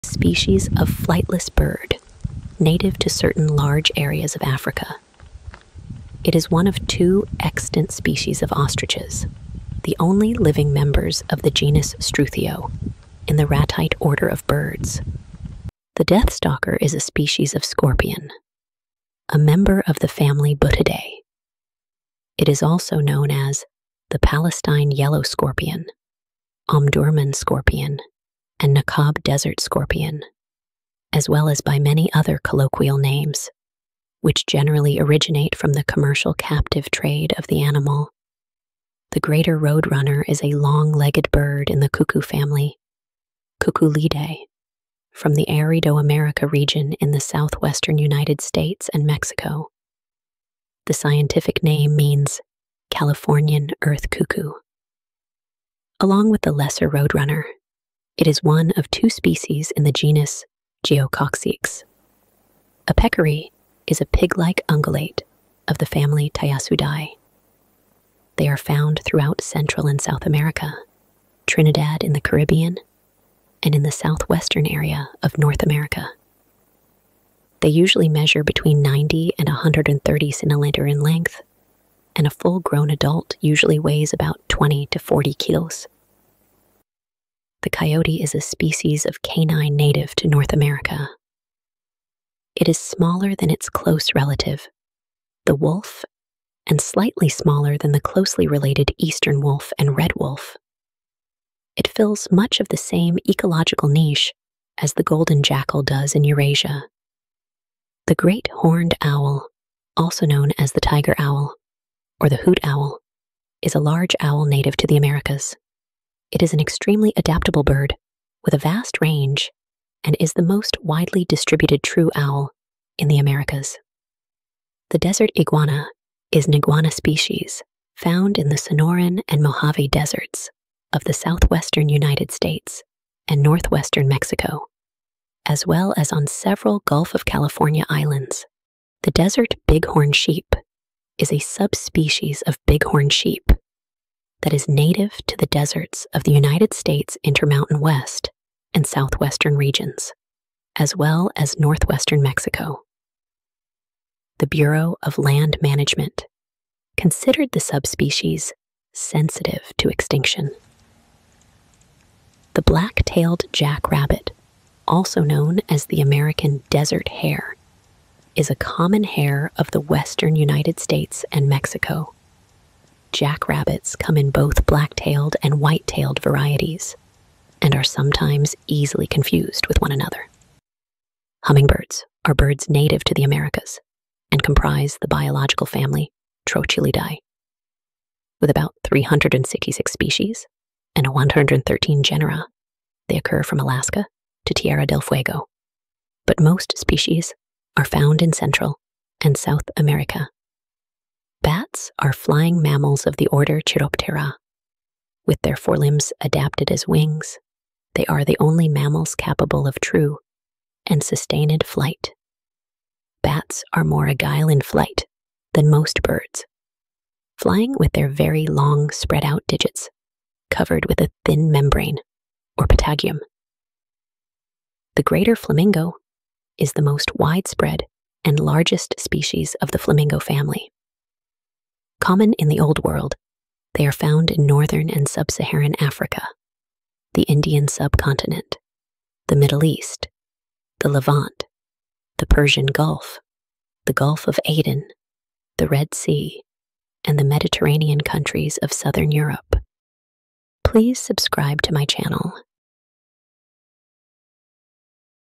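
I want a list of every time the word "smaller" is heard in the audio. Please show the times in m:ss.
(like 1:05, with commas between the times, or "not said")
1:32, 1:37.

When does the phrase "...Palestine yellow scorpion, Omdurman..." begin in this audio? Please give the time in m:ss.
0:24.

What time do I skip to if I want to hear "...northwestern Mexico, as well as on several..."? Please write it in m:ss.
2:13.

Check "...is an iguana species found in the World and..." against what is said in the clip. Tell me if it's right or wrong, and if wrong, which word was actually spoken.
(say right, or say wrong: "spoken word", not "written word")
wrong: "Sonoran", not "World".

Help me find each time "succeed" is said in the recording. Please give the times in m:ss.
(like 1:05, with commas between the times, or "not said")
not said.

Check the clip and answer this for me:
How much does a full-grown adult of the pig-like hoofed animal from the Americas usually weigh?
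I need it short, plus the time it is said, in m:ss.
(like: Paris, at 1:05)
20 to 40 kilos, at 1:24.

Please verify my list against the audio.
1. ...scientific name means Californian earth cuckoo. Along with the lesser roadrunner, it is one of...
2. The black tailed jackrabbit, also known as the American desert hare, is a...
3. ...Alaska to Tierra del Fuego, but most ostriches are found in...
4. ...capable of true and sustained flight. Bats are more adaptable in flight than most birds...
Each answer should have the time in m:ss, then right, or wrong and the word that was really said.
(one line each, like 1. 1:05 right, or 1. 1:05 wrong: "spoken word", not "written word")
1. 0:50 right
2. 2:42 right
3. 3:13 wrong: "species", not "ostriches"
4. 3:29 wrong: "agile", not "adaptable".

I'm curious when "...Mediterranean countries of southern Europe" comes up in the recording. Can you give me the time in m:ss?
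4:07.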